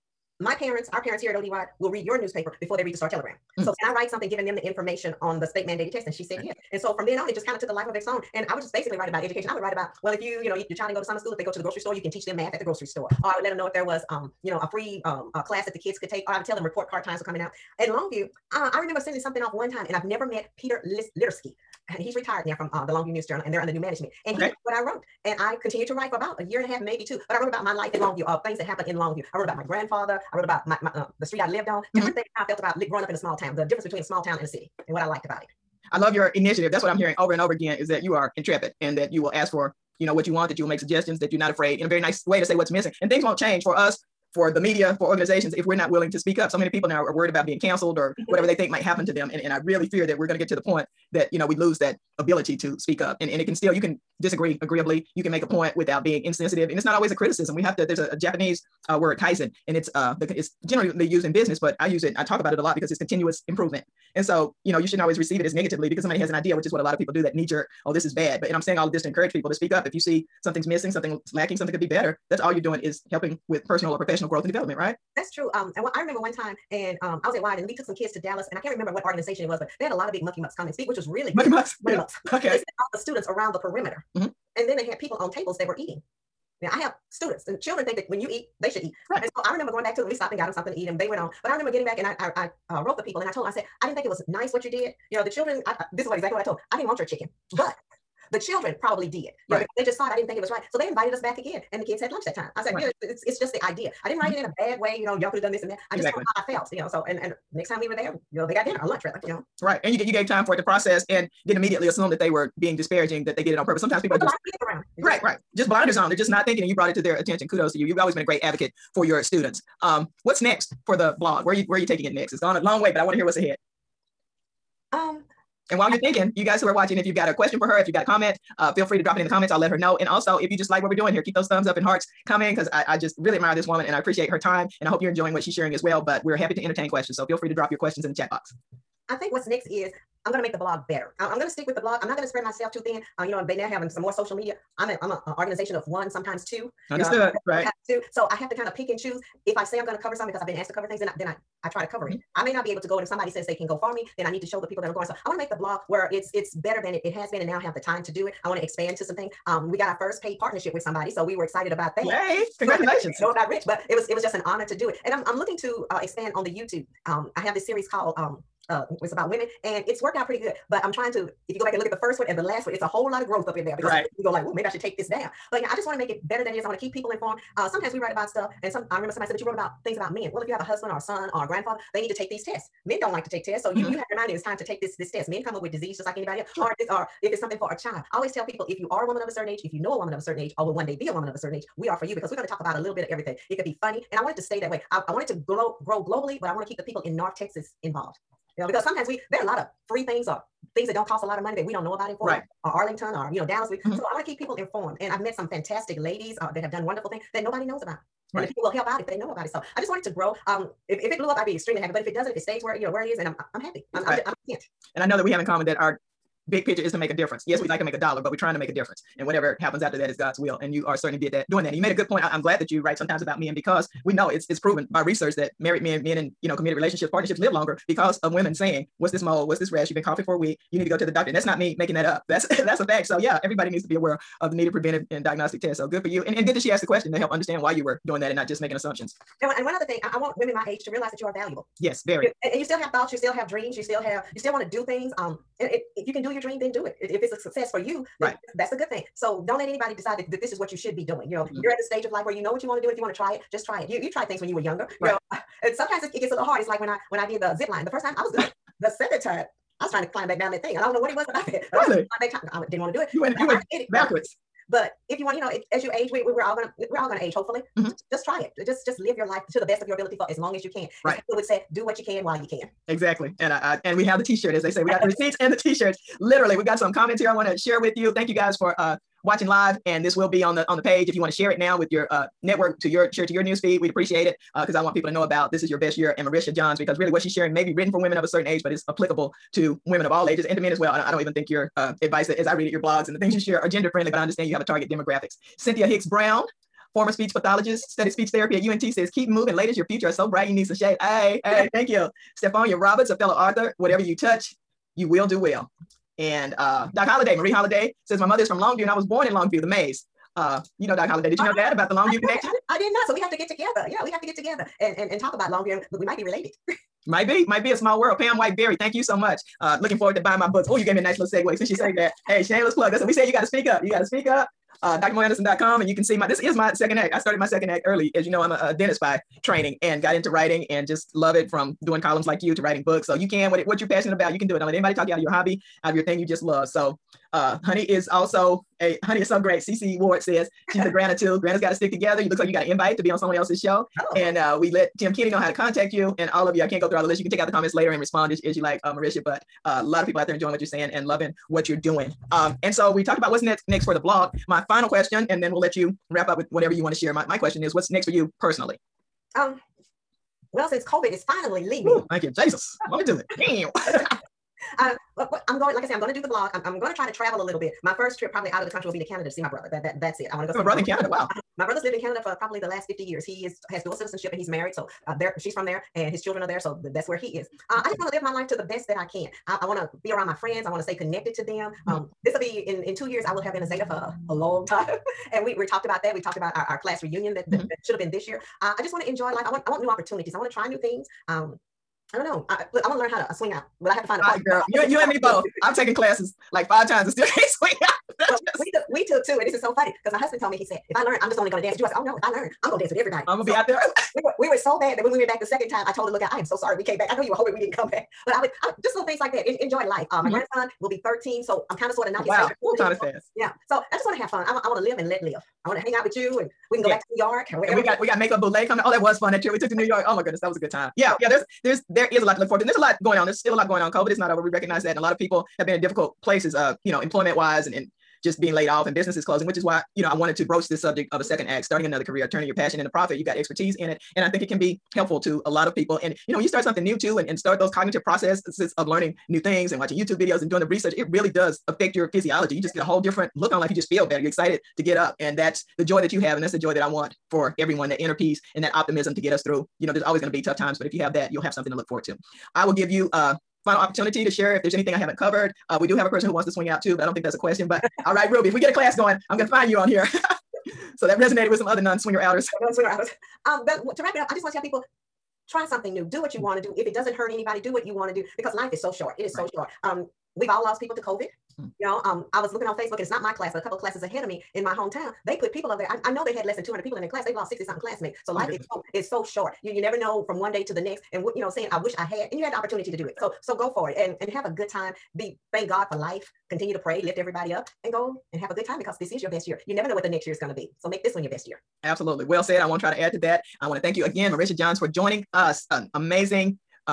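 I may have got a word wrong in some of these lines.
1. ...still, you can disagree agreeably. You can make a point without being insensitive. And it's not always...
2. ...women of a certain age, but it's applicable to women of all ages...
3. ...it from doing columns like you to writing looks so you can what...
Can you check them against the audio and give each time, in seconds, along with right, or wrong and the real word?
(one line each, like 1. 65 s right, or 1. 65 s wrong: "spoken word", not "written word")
1. 53 s right
2. 288 s right
3. 331 s wrong: "books", not "looks".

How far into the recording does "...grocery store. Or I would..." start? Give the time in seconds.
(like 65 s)
12 s.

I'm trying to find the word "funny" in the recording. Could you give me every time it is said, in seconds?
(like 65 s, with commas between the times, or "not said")
193 s, 399 s.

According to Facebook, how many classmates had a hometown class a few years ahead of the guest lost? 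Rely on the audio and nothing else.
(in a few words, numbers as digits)
60 something.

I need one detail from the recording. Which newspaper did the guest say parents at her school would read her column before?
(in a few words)
Star Telegram.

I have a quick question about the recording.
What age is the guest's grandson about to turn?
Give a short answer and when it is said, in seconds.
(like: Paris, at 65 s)
13, at 411 s.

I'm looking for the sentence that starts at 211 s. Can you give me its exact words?
But if it doesn't, if it stays where you know where it is, and I'm I'm happy.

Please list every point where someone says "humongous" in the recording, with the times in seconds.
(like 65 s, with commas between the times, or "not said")
not said.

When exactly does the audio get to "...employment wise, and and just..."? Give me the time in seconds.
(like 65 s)
427 s.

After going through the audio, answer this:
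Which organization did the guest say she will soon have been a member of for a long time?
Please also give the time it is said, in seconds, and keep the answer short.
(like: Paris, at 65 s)
Zeta, at 383 s.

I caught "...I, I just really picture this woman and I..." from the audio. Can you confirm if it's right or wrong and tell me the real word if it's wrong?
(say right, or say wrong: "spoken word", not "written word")
wrong: "admire", not "picture".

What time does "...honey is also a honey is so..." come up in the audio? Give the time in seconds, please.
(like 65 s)
337 s.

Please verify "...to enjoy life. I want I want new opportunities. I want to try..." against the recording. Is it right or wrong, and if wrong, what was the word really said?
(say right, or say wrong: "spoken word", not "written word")
right.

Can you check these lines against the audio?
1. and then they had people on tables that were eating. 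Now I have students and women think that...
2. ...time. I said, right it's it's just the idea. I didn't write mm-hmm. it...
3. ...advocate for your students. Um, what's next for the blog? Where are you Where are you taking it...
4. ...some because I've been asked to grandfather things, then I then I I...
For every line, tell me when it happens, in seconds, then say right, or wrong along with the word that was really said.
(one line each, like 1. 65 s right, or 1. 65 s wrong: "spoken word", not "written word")
1. 84 s wrong: "children", not "women"
2. 102 s right
3. 118 s right
4. 150 s wrong: "cover", not "grandfather".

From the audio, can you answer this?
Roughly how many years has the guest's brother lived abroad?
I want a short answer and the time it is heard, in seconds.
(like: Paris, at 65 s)
50, at 372 s.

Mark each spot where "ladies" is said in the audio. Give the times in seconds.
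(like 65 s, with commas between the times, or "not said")
205 s, 299 s.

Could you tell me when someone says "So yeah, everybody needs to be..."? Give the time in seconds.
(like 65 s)
233 s.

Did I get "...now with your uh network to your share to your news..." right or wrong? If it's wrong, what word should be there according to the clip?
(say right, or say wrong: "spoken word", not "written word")
right.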